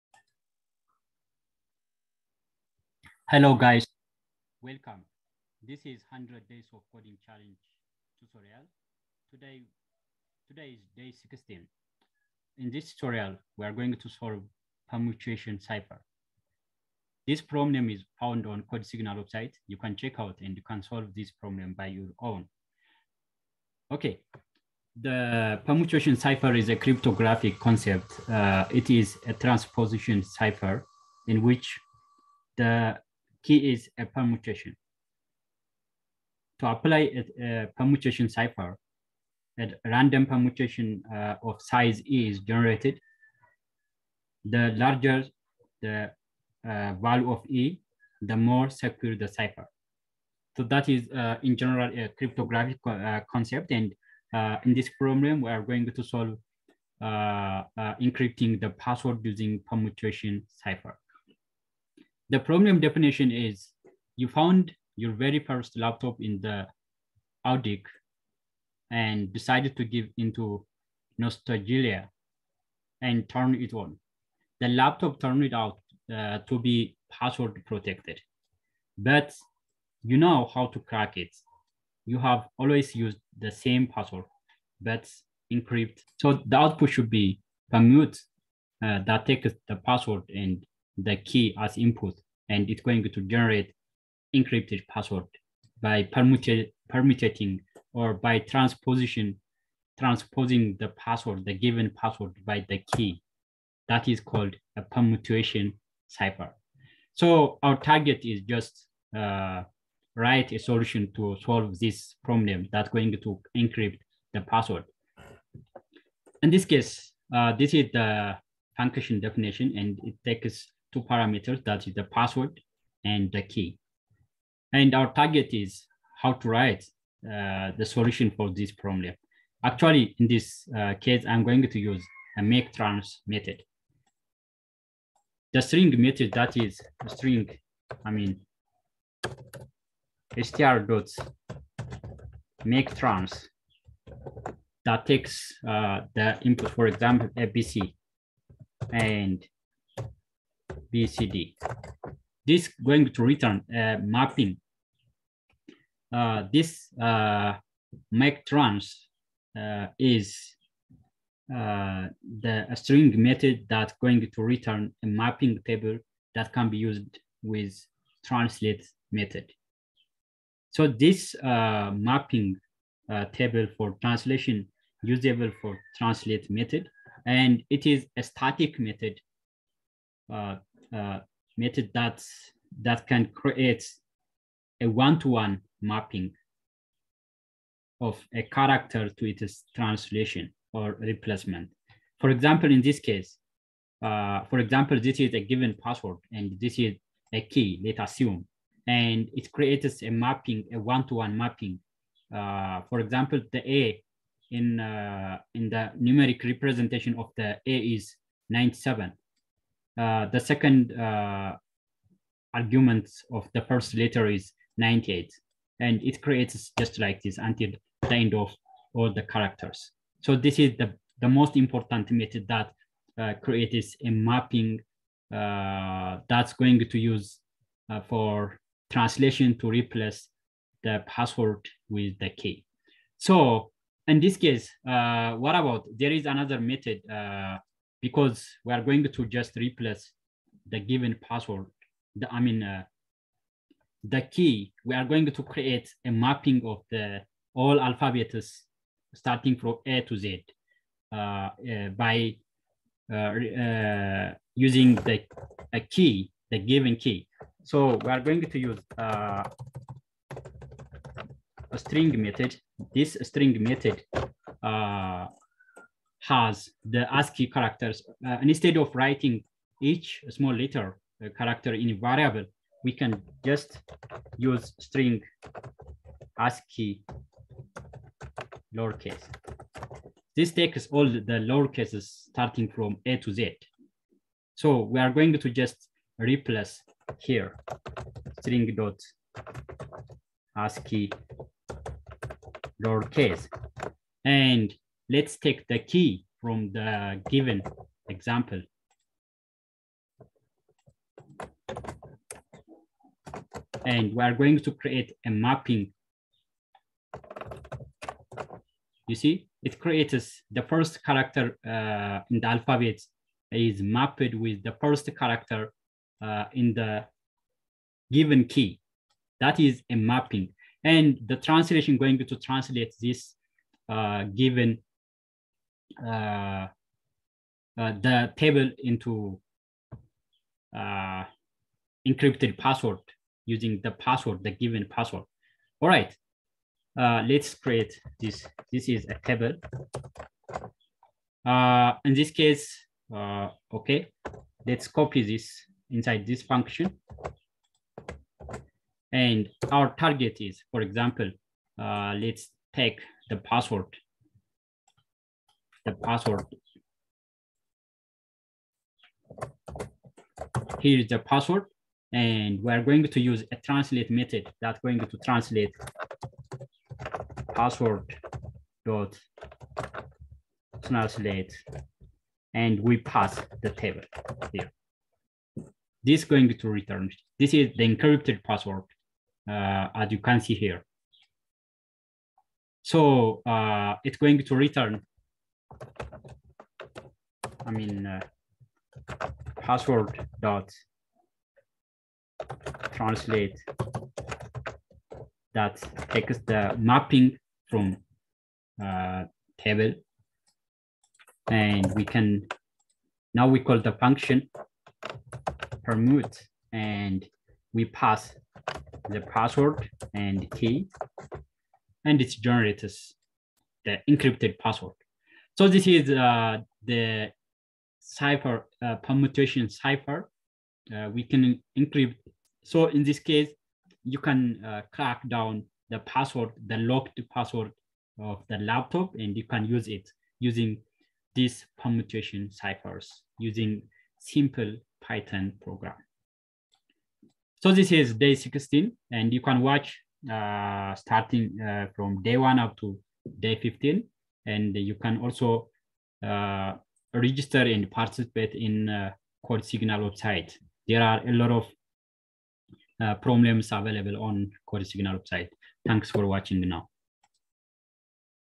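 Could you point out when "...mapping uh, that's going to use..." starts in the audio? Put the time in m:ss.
3:44.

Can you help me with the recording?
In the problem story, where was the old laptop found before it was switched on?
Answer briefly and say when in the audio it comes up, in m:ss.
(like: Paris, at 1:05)
the Audic, at 1:07.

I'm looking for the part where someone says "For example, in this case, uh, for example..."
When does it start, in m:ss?
3:12.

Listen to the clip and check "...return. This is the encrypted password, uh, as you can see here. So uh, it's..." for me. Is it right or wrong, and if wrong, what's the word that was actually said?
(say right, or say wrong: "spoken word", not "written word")
right.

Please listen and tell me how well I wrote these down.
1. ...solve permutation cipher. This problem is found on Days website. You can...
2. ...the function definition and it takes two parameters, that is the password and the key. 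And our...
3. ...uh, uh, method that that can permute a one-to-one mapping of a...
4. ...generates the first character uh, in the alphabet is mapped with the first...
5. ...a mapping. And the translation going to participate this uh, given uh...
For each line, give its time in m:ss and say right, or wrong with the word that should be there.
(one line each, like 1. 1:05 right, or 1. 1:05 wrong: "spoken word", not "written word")
1. 0:14 wrong: "CodeSignal", not "Days"
2. 1:57 right
3. 3:00 wrong: "create", not "permute"
4. 5:09 wrong: "creates", not "generates"
5. 5:19 wrong: "translate", not "participate".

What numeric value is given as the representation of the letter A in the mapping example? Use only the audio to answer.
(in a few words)
97.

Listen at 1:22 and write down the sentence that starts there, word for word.
You have always used the same password, but encrypt.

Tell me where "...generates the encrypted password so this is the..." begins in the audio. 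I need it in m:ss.
6:52.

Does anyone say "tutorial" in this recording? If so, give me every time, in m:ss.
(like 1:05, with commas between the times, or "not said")
0:08, 0:12.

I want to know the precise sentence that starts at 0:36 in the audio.
To apply a, a permutation cipher, a random permutation uh, of size E is generated.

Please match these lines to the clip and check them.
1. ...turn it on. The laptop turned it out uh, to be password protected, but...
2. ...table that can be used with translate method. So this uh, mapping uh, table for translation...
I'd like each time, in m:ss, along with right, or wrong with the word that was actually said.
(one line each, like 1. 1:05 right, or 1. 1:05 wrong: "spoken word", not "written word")
1. 1:13 right
2. 2:45 right.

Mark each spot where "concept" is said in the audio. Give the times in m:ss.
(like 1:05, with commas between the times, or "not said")
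0:27, 0:53.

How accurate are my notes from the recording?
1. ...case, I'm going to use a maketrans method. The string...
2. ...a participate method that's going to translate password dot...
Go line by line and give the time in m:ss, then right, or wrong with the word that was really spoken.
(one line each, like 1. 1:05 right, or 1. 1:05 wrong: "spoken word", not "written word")
1. 2:10 right
2. 6:03 wrong: "translate", not "participate".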